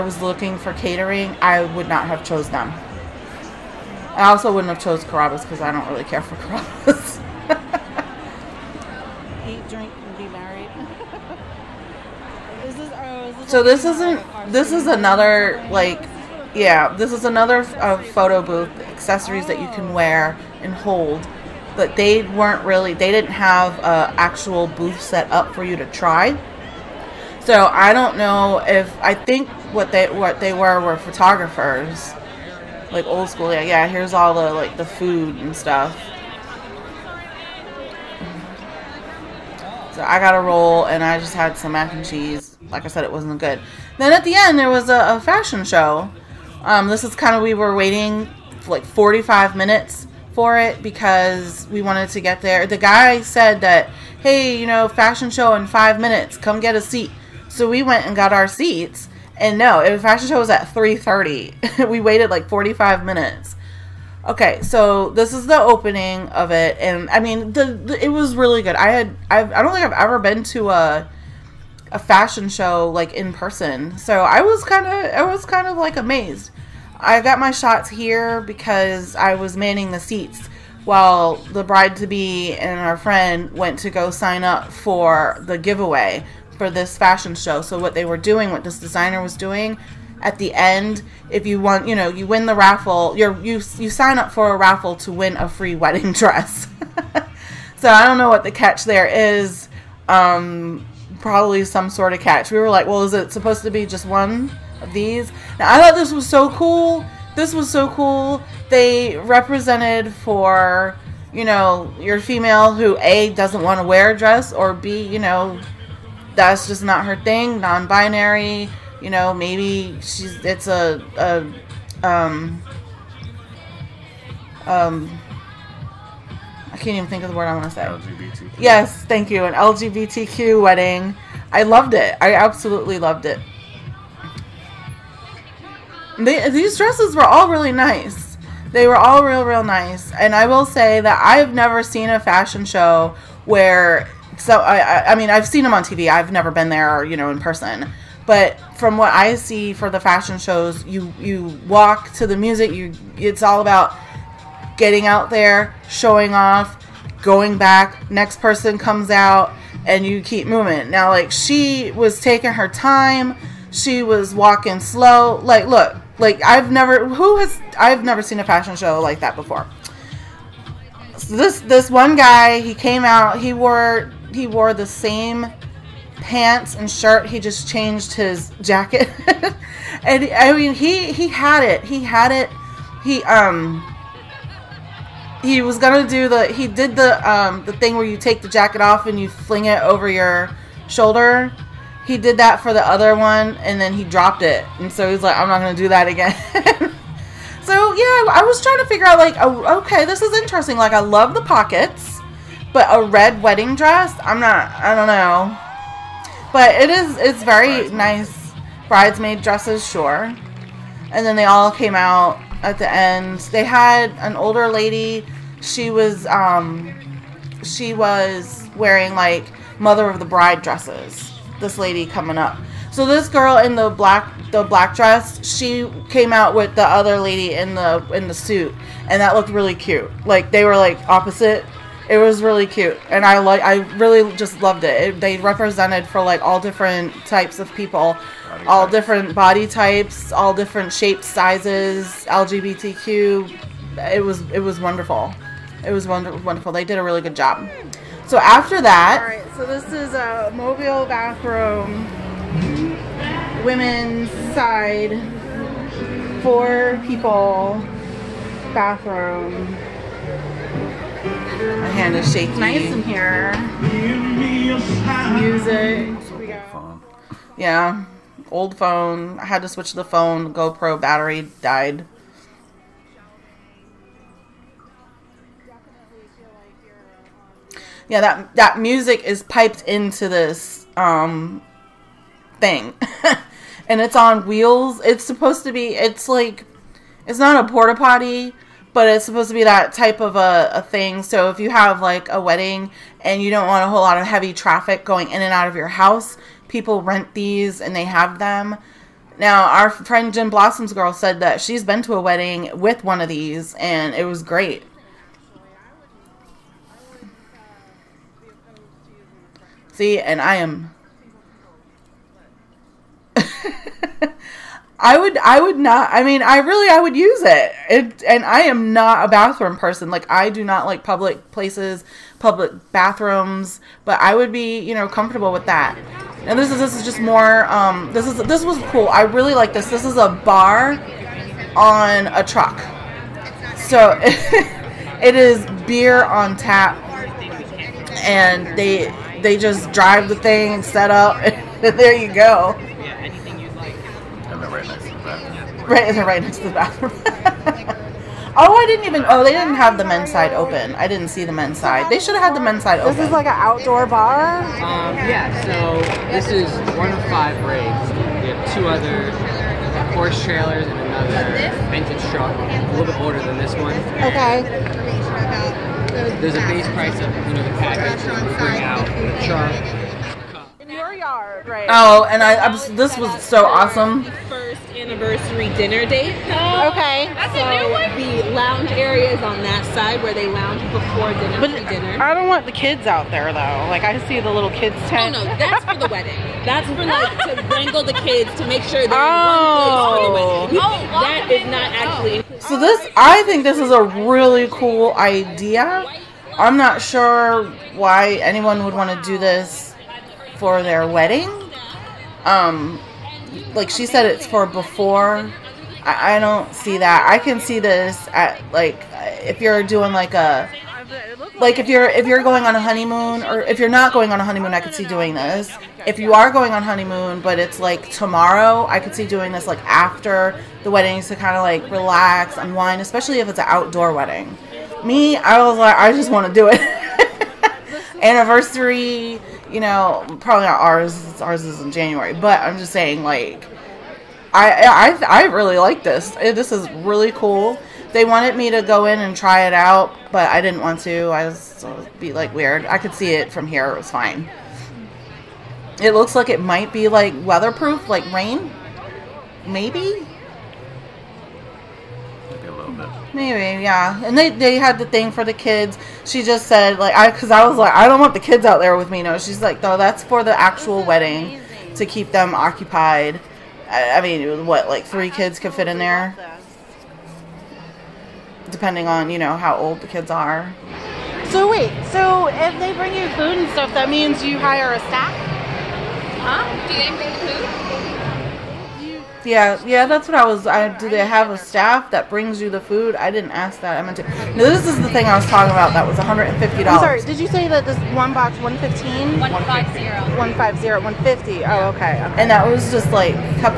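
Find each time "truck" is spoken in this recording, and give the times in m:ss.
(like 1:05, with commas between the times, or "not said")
5:32, 6:02.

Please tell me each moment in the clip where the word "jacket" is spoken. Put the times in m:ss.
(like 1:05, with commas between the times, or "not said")
2:58, 3:08.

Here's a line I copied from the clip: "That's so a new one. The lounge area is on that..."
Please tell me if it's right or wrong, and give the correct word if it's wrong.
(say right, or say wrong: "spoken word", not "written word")
right.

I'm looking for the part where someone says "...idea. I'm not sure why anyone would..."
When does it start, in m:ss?
6:35.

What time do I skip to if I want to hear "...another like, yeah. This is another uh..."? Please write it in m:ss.
0:14.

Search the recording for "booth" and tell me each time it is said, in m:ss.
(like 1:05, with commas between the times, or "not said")
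0:18, 0:24.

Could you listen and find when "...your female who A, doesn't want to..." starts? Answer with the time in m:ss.
1:51.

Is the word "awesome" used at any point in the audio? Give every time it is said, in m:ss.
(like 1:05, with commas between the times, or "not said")
6:13.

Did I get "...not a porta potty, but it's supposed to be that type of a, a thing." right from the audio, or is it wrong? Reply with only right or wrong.
right.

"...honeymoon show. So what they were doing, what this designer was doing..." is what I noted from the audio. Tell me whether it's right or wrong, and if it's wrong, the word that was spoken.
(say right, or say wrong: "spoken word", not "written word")
wrong: "fashion", not "honeymoon".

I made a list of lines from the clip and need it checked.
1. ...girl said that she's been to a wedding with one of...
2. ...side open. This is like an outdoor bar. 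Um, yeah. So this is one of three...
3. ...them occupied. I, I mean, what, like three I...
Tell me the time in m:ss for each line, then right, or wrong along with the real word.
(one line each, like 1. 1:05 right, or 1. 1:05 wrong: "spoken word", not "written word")
1. 5:00 right
2. 5:52 wrong: "five", not "three"
3. 7:42 right.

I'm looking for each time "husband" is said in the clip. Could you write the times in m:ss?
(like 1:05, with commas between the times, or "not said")
not said.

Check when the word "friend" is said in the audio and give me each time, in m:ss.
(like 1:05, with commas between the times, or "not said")
1:22, 4:59.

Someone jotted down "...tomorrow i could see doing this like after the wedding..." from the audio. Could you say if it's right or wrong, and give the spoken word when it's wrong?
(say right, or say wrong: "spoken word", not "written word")
right.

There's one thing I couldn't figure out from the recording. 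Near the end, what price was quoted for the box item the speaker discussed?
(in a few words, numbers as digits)
$150.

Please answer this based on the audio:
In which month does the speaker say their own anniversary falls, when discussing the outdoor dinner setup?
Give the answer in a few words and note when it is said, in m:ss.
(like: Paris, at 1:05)
January, at 7:11.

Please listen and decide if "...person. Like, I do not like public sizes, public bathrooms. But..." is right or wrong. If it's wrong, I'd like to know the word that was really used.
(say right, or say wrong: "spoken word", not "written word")
wrong: "places", not "sizes".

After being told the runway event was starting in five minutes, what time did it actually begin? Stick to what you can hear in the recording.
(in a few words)
3:30.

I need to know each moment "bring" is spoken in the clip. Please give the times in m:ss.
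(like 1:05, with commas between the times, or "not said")
6:08, 7:52, 7:57, 8:02.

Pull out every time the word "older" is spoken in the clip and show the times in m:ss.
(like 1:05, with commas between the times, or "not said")
3:34, 6:03.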